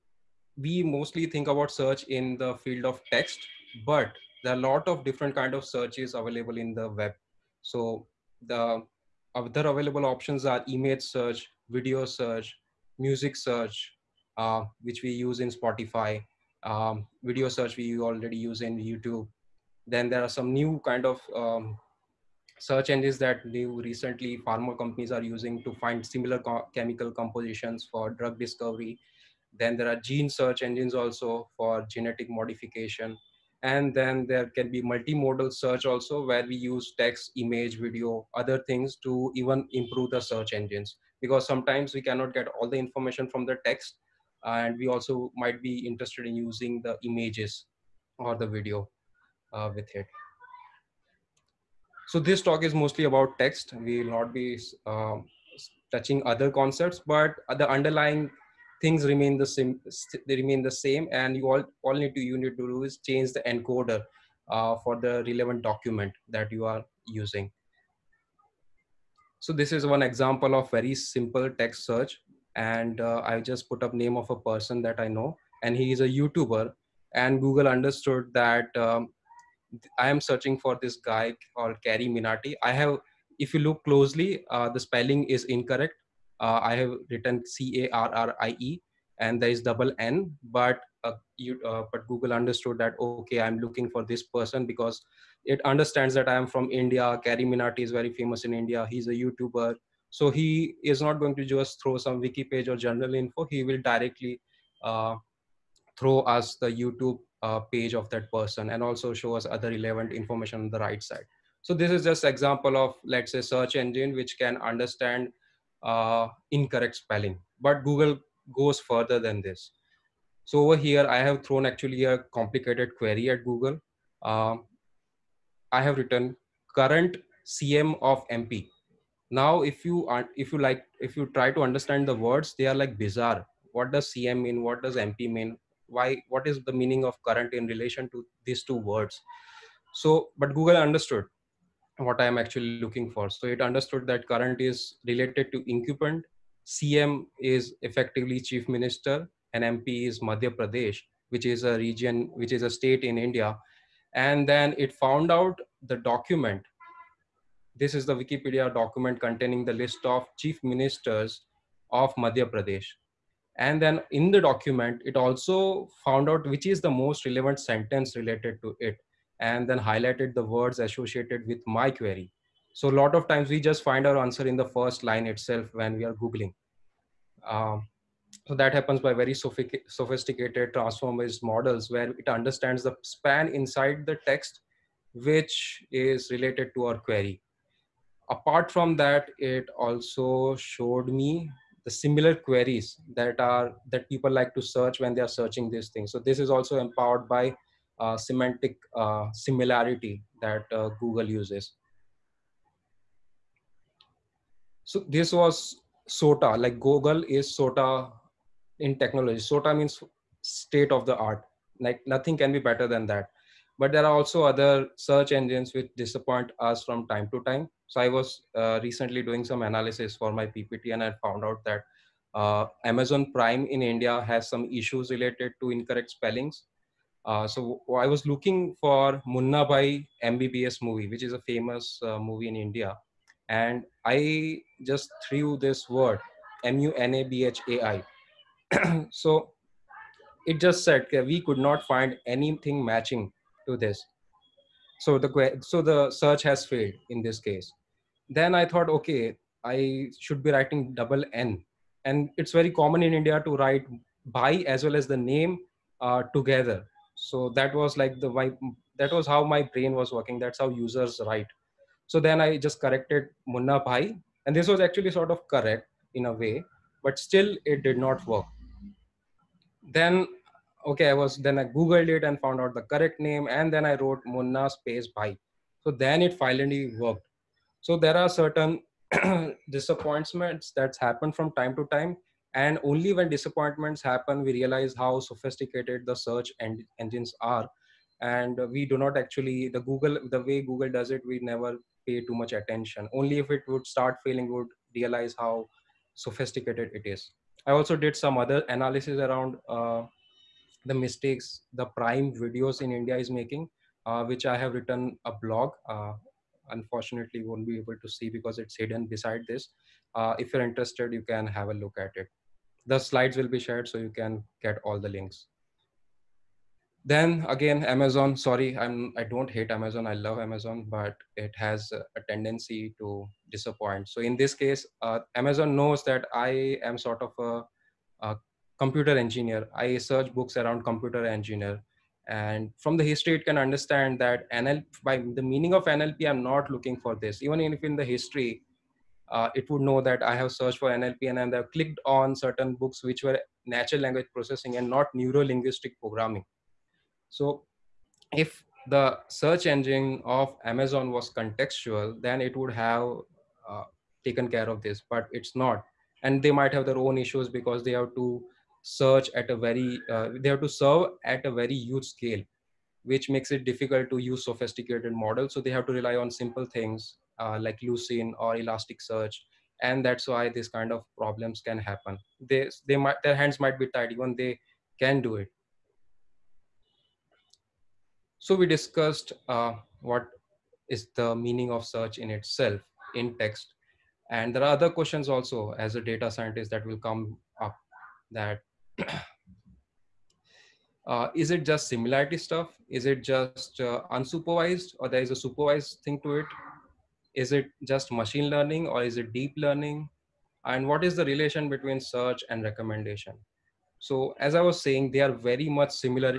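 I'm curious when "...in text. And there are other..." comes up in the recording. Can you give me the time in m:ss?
6:23.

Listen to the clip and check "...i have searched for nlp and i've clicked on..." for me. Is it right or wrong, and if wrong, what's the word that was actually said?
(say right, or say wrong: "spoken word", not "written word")
right.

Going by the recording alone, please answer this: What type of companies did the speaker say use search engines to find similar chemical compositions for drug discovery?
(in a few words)
pharma companies.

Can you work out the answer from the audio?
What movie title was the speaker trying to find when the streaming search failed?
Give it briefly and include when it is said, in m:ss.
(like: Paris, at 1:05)
Munna Bhai MBBS, at 3:49.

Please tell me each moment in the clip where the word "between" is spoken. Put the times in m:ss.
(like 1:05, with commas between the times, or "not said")
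6:41.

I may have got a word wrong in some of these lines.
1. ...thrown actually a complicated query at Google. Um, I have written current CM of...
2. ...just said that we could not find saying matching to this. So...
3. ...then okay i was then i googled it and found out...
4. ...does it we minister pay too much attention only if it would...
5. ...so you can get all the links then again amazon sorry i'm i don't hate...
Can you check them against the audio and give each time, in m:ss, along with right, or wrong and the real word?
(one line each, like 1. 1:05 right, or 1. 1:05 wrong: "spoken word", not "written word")
1. 2:01 right
2. 4:00 wrong: "anything", not "saying"
3. 4:29 right
4. 4:50 wrong: "never", not "minister"
5. 5:13 right.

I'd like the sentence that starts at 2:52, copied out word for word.
So a lot of times we just find our answer in the first line itself when we are Googling.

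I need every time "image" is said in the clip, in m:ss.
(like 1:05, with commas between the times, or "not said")
0:10, 0:37, 0:47.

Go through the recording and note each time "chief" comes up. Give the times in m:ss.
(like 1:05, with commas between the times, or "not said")
2:28, 2:40.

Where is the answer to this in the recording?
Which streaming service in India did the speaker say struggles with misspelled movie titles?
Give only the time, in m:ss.
3:42.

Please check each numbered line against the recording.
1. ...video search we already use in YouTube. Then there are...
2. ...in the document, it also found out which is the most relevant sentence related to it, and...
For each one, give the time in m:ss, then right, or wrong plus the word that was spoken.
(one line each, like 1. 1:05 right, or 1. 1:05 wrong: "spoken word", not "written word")
1. 0:17 right
2. 2:44 right.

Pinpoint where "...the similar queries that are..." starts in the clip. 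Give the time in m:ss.
3:11.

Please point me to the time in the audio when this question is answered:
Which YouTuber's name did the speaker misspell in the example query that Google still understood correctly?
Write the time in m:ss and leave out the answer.
1:21.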